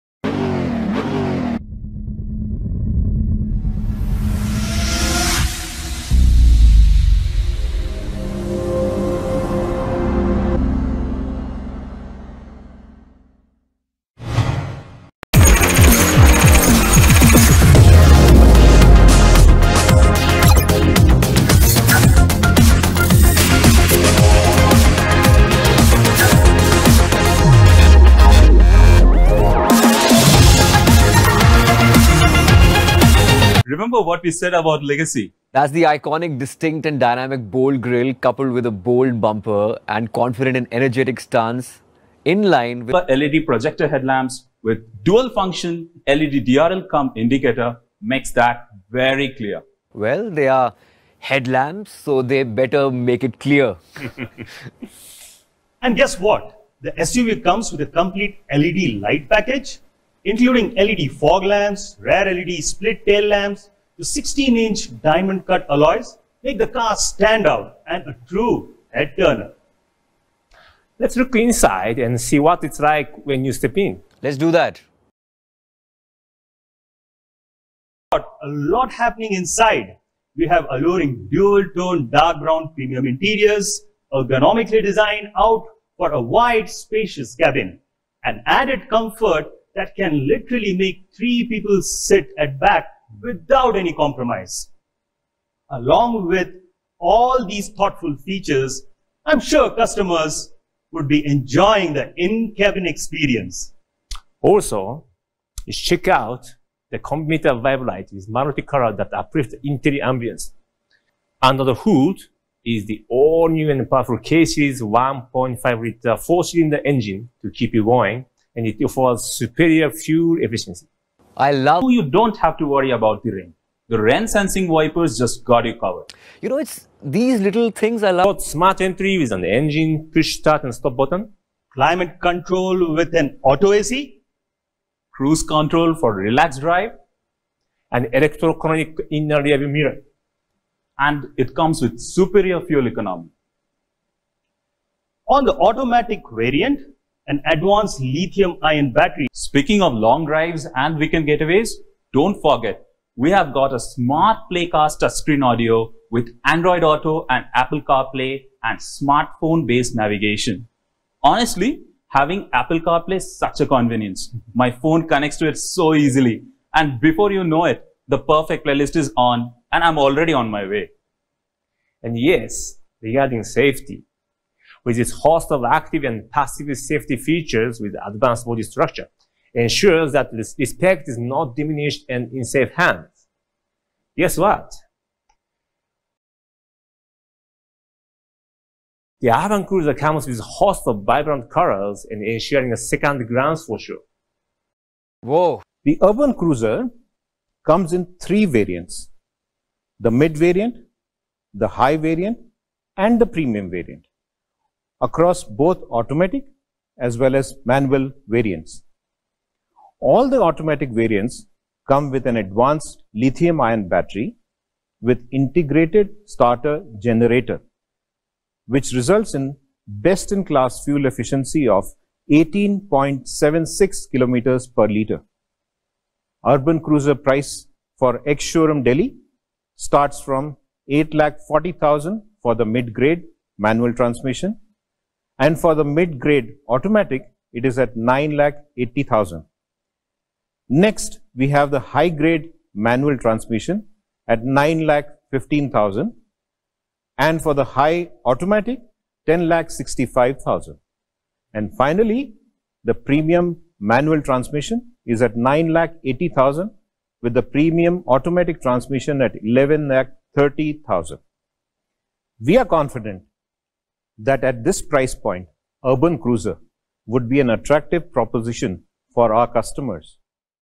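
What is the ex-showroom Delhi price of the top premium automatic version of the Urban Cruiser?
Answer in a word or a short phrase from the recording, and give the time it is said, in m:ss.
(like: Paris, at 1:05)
11 lakh 30,000, at 4:19.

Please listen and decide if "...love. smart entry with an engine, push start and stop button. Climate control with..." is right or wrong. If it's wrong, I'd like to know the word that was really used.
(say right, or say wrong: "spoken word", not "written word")
right.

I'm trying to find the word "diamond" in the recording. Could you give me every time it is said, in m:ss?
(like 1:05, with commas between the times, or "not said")
1:05.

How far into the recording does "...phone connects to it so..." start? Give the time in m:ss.
2:44.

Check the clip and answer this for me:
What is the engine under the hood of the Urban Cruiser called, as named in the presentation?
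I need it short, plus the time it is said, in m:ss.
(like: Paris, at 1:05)
K-Series, at 1:54.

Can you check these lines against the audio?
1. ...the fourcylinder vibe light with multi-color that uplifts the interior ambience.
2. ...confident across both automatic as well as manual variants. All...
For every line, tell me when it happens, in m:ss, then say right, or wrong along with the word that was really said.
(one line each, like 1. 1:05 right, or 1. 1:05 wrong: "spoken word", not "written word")
1. 1:46 wrong: "computer", not "fourcylinder"
2. 3:23 wrong: "variant", not "confident".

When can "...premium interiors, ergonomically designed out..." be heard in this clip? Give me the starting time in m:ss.
1:22.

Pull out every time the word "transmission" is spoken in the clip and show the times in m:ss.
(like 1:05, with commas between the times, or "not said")
3:53, 4:03, 4:14, 4:18.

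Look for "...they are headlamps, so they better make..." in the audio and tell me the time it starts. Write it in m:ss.
0:50.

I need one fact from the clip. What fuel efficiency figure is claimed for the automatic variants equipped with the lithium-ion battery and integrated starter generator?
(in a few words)
18.76 km/l.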